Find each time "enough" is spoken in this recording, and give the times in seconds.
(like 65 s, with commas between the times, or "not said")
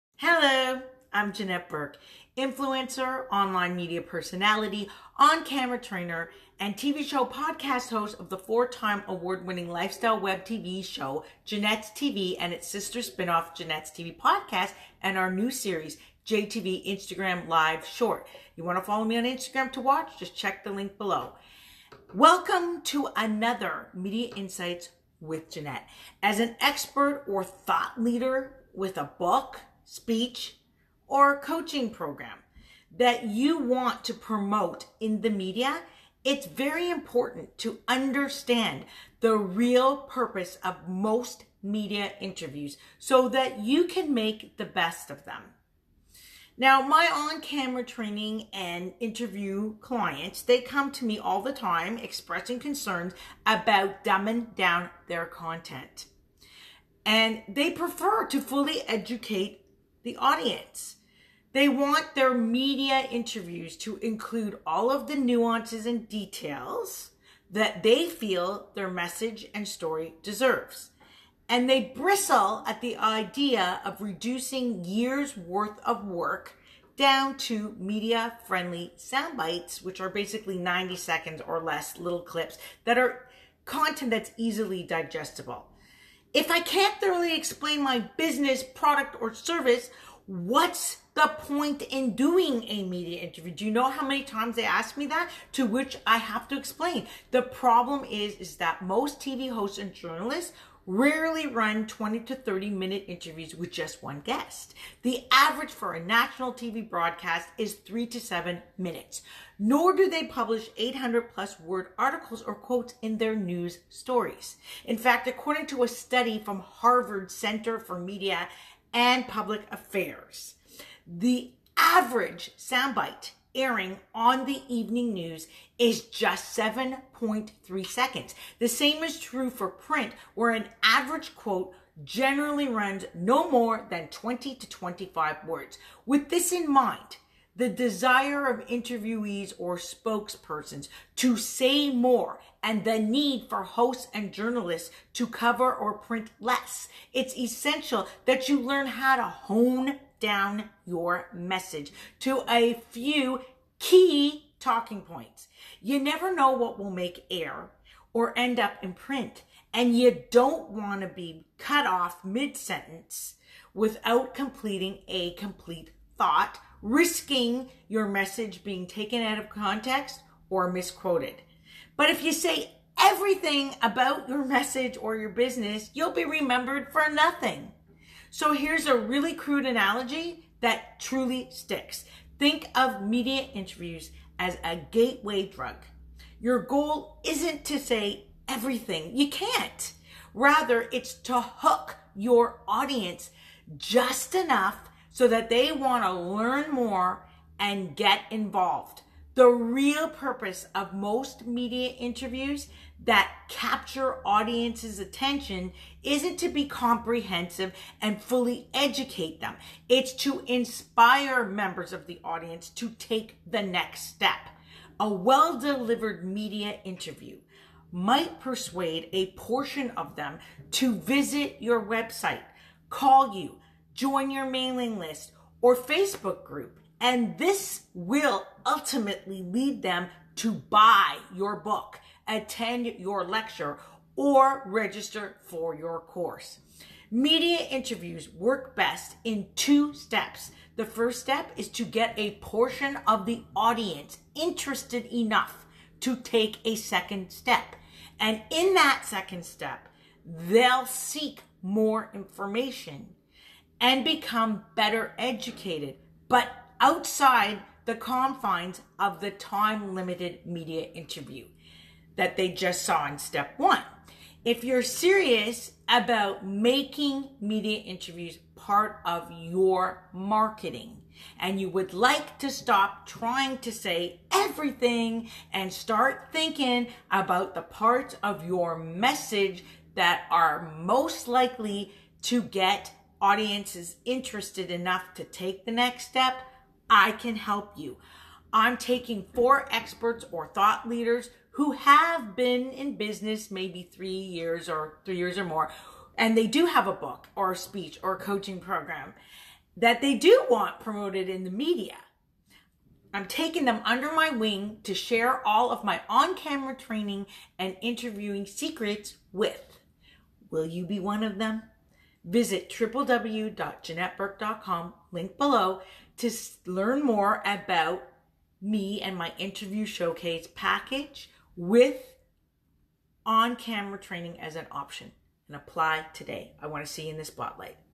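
194 s, 245 s, 284 s.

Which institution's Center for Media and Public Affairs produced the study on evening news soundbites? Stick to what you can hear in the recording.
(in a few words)
Harvard.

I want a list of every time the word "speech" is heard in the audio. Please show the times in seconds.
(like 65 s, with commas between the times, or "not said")
29 s, 297 s.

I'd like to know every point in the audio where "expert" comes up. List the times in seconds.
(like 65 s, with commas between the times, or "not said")
26 s, 289 s.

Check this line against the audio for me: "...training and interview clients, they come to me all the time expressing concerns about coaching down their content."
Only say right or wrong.
wrong.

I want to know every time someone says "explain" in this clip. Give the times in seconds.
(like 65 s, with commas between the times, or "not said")
87 s, 96 s.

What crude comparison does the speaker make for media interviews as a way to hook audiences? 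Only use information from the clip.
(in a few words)
gateway drug.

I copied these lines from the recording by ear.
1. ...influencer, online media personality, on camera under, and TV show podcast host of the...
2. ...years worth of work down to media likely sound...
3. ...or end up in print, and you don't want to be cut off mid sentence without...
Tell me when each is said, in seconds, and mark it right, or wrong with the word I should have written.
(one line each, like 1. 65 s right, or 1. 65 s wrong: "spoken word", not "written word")
1. 2 s wrong: "trainer", not "under"
2. 74 s wrong: "friendly", not "likely"
3. 158 s right.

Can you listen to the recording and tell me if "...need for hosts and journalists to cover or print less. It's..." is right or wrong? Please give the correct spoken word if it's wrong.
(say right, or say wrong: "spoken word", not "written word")
right.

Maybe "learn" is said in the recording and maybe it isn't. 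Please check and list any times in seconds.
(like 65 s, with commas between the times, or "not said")
148 s, 196 s, 316 s.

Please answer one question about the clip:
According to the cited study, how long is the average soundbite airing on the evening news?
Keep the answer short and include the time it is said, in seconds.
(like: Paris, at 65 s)
7.3 seconds, at 126 s.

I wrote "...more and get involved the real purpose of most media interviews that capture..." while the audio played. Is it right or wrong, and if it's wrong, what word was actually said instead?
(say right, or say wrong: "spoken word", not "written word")
right.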